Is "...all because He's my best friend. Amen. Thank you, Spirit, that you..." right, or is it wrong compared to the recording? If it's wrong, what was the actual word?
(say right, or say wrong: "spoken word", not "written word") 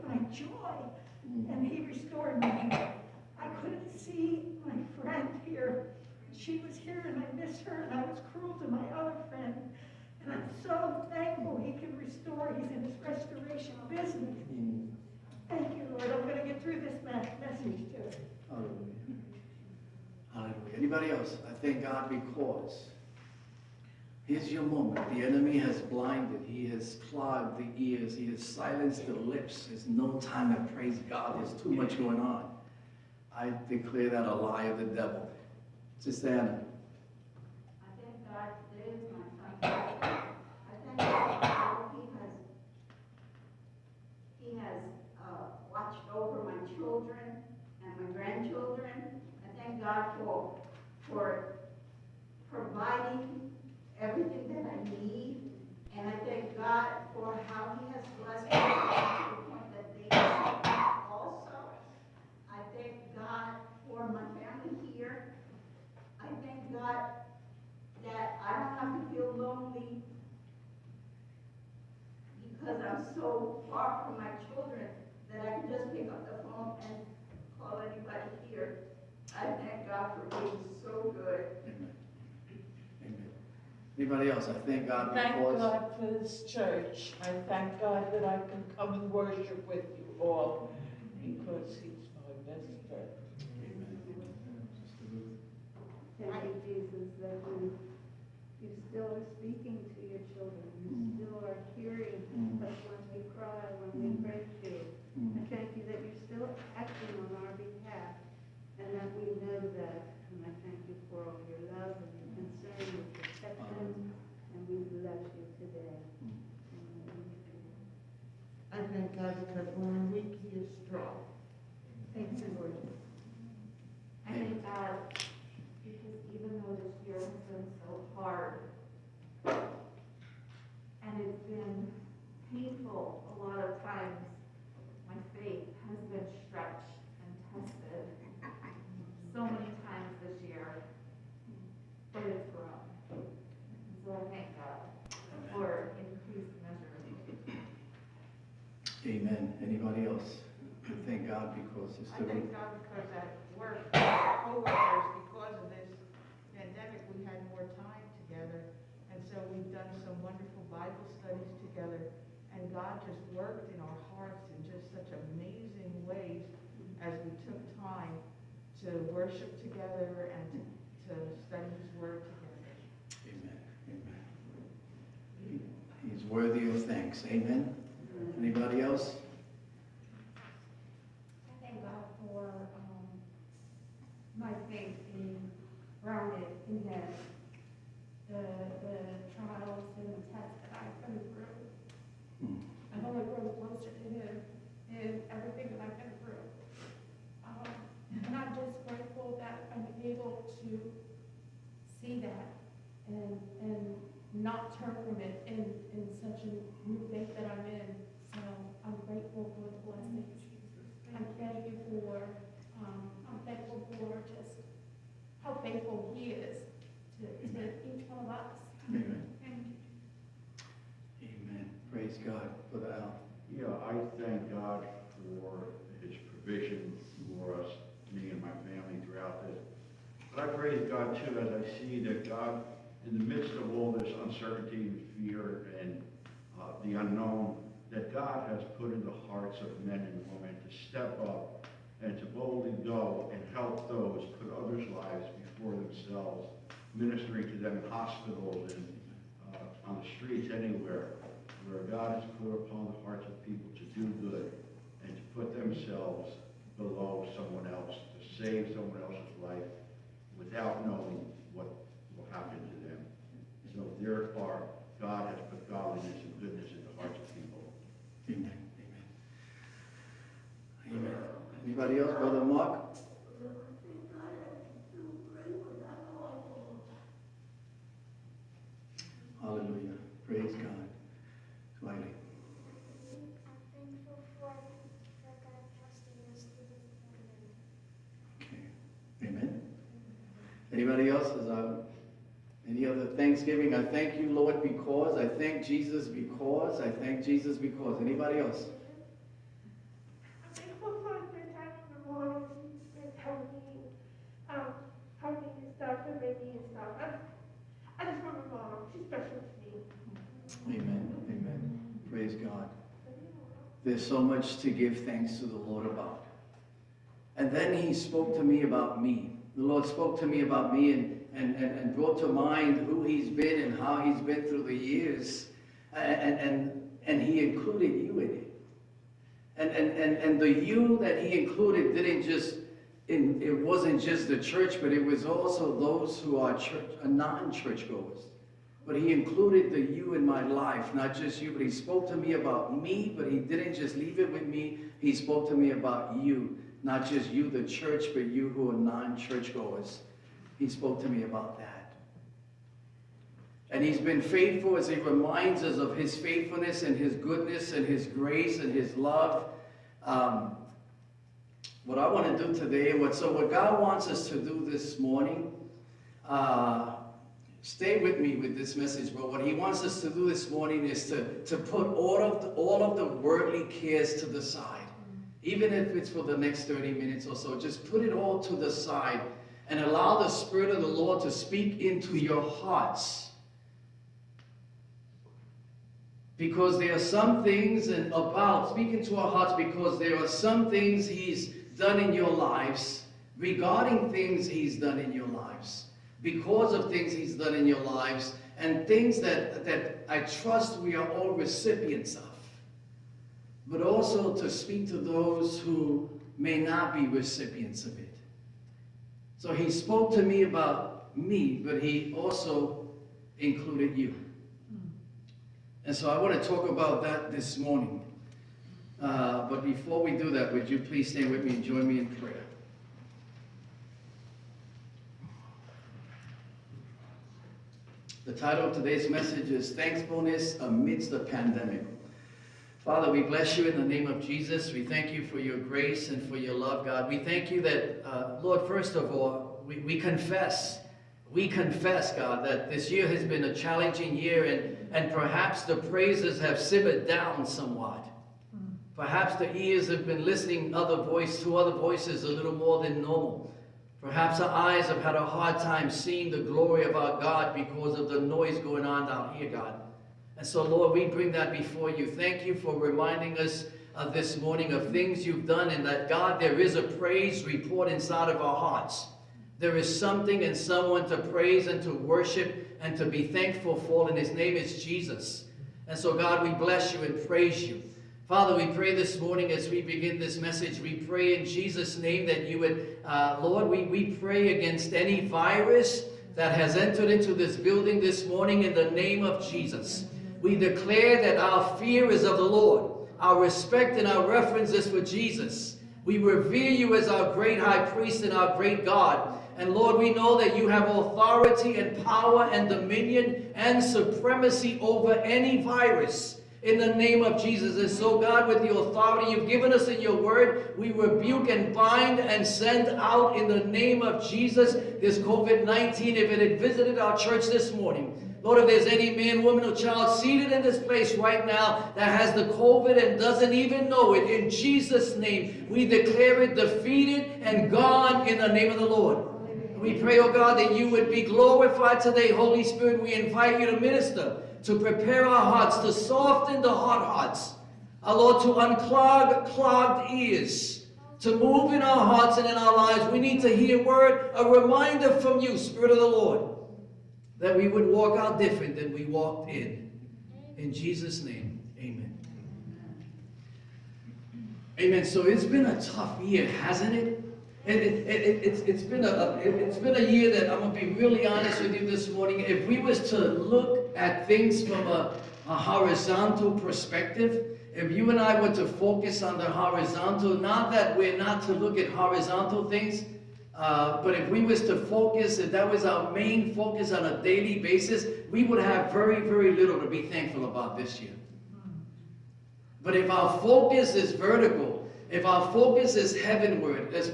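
wrong: "Jesus", not "Spirit".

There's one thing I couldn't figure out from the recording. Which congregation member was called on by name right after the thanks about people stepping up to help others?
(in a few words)
Brother Mark.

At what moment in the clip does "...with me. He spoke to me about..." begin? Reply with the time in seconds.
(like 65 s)
344 s.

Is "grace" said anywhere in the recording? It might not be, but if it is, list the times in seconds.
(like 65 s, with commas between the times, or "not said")
358 s, 435 s.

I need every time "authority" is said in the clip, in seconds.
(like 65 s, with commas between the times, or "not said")
500 s, 508 s.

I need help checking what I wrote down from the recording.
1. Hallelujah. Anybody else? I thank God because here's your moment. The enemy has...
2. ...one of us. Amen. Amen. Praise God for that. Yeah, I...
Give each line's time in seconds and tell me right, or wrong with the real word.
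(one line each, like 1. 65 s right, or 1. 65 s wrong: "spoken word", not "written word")
1. 20 s right
2. 218 s right.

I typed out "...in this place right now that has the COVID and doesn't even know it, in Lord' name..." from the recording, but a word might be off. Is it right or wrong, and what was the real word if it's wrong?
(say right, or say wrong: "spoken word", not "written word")
wrong: "Jesus", not "Lord".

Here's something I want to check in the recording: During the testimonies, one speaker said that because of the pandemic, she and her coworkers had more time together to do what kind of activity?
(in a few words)
Bible studies.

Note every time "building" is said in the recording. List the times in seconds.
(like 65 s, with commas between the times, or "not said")
487 s.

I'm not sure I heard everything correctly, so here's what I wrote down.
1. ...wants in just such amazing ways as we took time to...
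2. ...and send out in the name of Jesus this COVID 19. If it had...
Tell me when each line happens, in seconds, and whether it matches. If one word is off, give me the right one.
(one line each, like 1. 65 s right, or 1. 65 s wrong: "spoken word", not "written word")
1. 164 s wrong: "hearts", not "wants"
2. 512 s right.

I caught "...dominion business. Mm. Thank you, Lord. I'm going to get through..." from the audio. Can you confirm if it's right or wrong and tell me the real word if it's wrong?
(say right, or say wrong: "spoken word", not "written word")
wrong: "restoration", not "dominion".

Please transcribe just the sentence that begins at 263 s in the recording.
So there are God has put godliness and goodness in the hearts of people.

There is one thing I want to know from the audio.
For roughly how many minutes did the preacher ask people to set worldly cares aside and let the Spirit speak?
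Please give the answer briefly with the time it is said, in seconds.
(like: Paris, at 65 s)
30, at 376 s.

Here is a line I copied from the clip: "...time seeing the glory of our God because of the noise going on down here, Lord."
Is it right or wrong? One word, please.
wrong.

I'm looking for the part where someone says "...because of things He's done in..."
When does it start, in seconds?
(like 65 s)
396 s.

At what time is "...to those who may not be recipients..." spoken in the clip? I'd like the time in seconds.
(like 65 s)
404 s.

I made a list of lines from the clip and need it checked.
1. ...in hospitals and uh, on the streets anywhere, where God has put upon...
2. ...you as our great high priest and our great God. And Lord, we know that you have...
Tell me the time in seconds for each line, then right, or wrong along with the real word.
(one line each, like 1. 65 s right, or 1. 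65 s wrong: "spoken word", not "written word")
1. 247 s right
2. 496 s right.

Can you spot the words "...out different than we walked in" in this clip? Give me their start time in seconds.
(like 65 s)
548 s.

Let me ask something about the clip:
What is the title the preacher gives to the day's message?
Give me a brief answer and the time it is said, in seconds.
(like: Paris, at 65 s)
Thankfulness Amidst the Pandemic, at 429 s.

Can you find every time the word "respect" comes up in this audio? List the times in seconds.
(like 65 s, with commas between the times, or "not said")
493 s.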